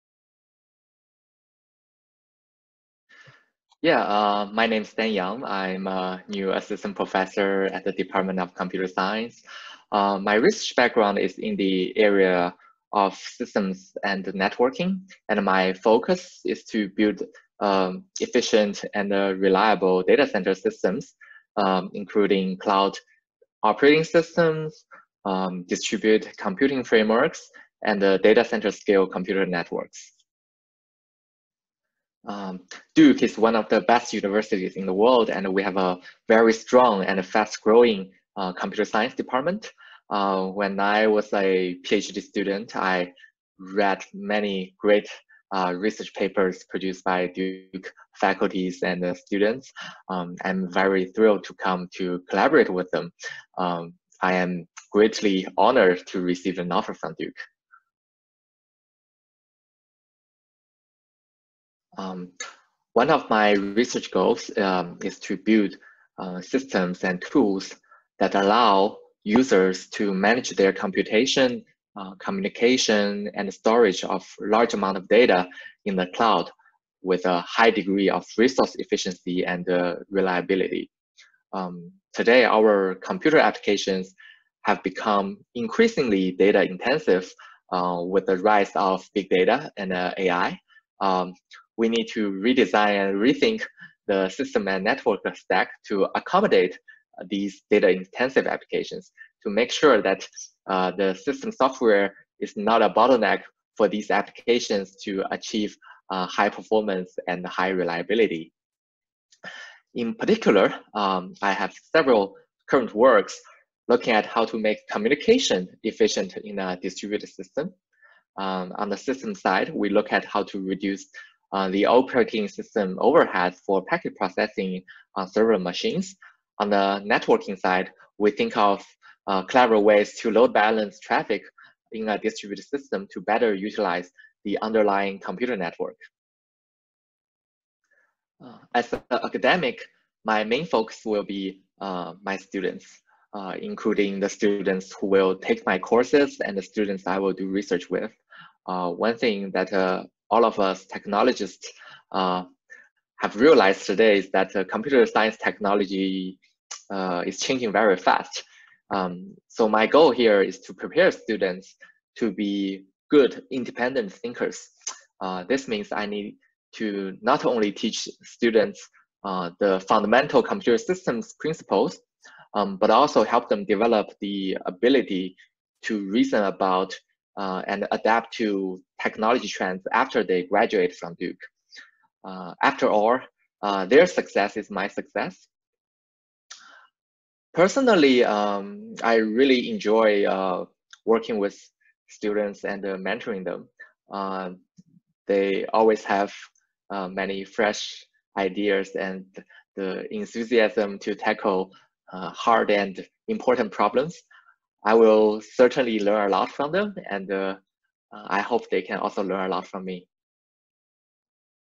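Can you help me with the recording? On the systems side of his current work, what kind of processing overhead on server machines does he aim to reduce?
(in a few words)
packet processing.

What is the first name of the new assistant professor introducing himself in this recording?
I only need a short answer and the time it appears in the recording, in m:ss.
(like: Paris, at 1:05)
Danyang, at 0:04.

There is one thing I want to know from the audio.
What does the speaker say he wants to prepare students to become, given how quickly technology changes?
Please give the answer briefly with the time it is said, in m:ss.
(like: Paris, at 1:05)
good independent thinkers, at 2:43.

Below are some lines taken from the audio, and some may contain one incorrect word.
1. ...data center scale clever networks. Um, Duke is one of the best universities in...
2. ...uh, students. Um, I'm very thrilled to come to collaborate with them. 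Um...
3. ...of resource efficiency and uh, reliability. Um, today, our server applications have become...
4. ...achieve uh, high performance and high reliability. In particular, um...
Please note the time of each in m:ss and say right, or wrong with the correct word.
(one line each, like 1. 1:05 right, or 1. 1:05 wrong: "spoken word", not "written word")
1. 0:28 wrong: "computer", not "clever"
2. 0:49 right
3. 1:18 wrong: "computer", not "server"
4. 1:45 right.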